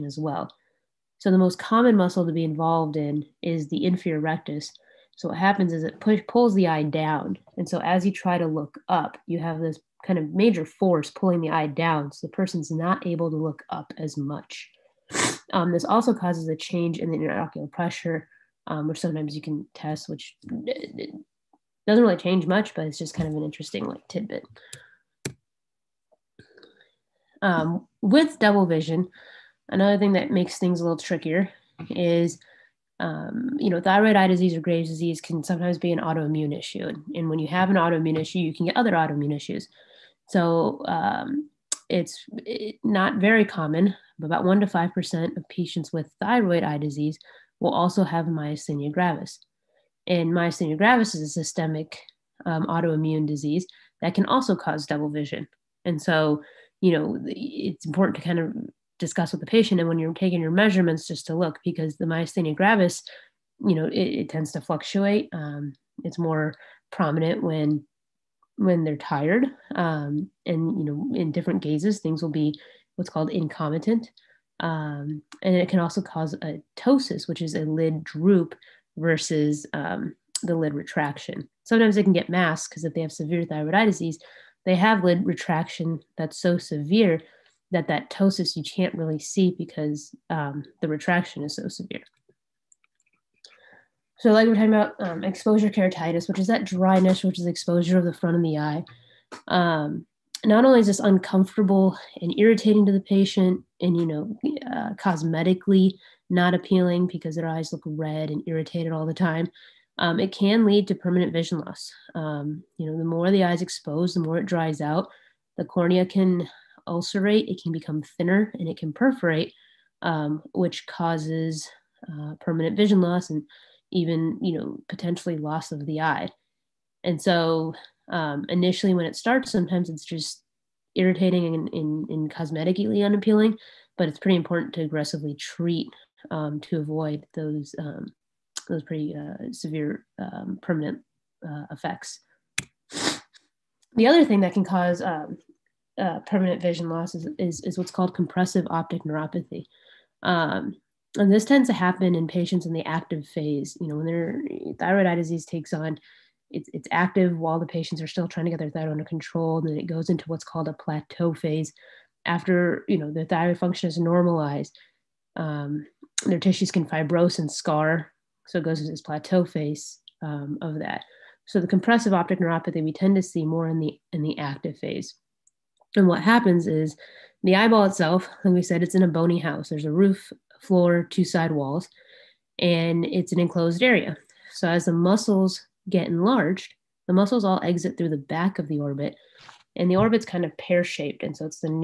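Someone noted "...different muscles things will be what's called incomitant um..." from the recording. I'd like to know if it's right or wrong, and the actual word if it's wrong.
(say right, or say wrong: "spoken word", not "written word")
wrong: "gazes", not "muscles".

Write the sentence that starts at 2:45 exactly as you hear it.
Um, their tissues can fibrose and scar.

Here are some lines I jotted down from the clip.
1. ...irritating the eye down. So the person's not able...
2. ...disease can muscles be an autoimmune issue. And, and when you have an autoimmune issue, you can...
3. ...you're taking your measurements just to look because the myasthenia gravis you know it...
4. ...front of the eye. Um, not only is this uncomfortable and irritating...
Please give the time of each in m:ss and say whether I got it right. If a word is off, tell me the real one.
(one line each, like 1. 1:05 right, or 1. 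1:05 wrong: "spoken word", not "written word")
1. 0:11 wrong: "pulling", not "irritating"
2. 0:34 wrong: "sometimes", not "muscles"
3. 0:59 right
4. 1:38 right.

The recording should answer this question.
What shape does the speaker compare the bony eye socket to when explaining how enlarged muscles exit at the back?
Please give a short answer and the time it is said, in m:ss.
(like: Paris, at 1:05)
Pear shaped, at 3:10.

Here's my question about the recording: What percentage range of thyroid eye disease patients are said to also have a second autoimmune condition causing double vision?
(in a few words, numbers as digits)
1% to 5%.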